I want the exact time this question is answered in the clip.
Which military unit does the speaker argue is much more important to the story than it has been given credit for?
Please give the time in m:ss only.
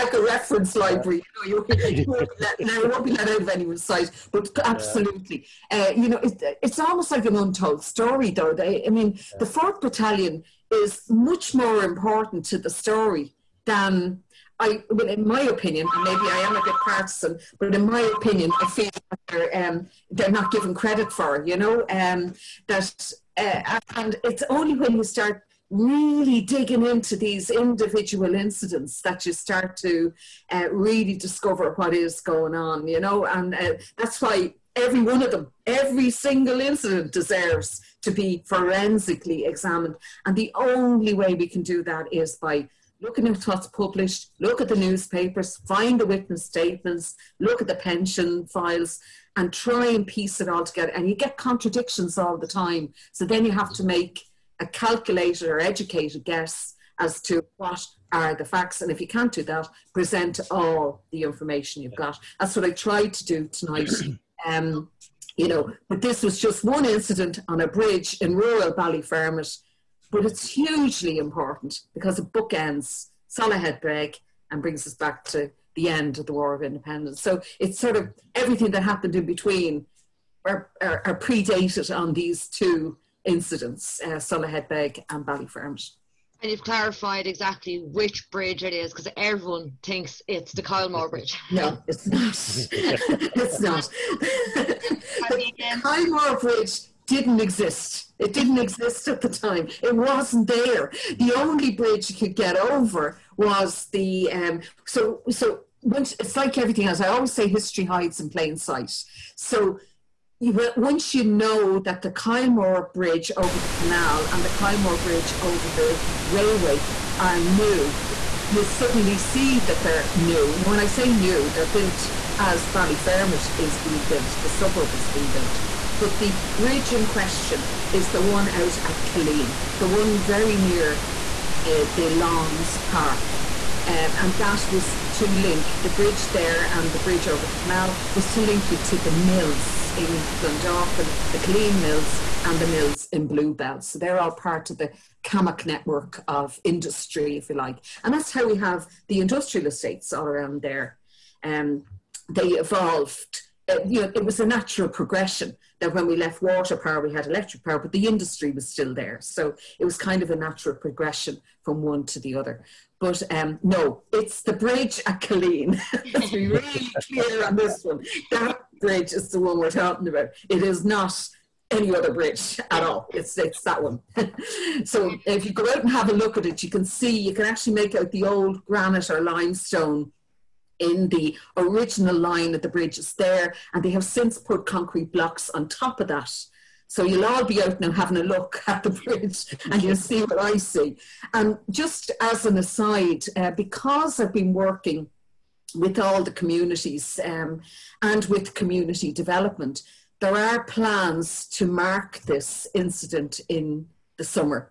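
0:09.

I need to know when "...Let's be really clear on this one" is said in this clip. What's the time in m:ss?
2:46.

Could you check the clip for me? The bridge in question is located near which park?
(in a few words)
Lawns Park.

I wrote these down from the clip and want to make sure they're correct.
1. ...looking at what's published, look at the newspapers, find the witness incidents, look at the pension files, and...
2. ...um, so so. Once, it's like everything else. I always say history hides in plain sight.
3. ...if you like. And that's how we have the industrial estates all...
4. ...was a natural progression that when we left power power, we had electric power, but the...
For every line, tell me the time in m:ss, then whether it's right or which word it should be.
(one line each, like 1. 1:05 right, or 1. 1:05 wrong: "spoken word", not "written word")
1. 0:43 wrong: "statements", not "incidents"
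2. 1:44 right
3. 2:27 right
4. 2:34 wrong: "water", not "power".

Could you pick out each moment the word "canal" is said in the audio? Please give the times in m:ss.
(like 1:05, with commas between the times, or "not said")
1:53, 2:17.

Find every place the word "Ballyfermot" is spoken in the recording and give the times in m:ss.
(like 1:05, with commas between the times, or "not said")
1:08, 1:25, 2:02.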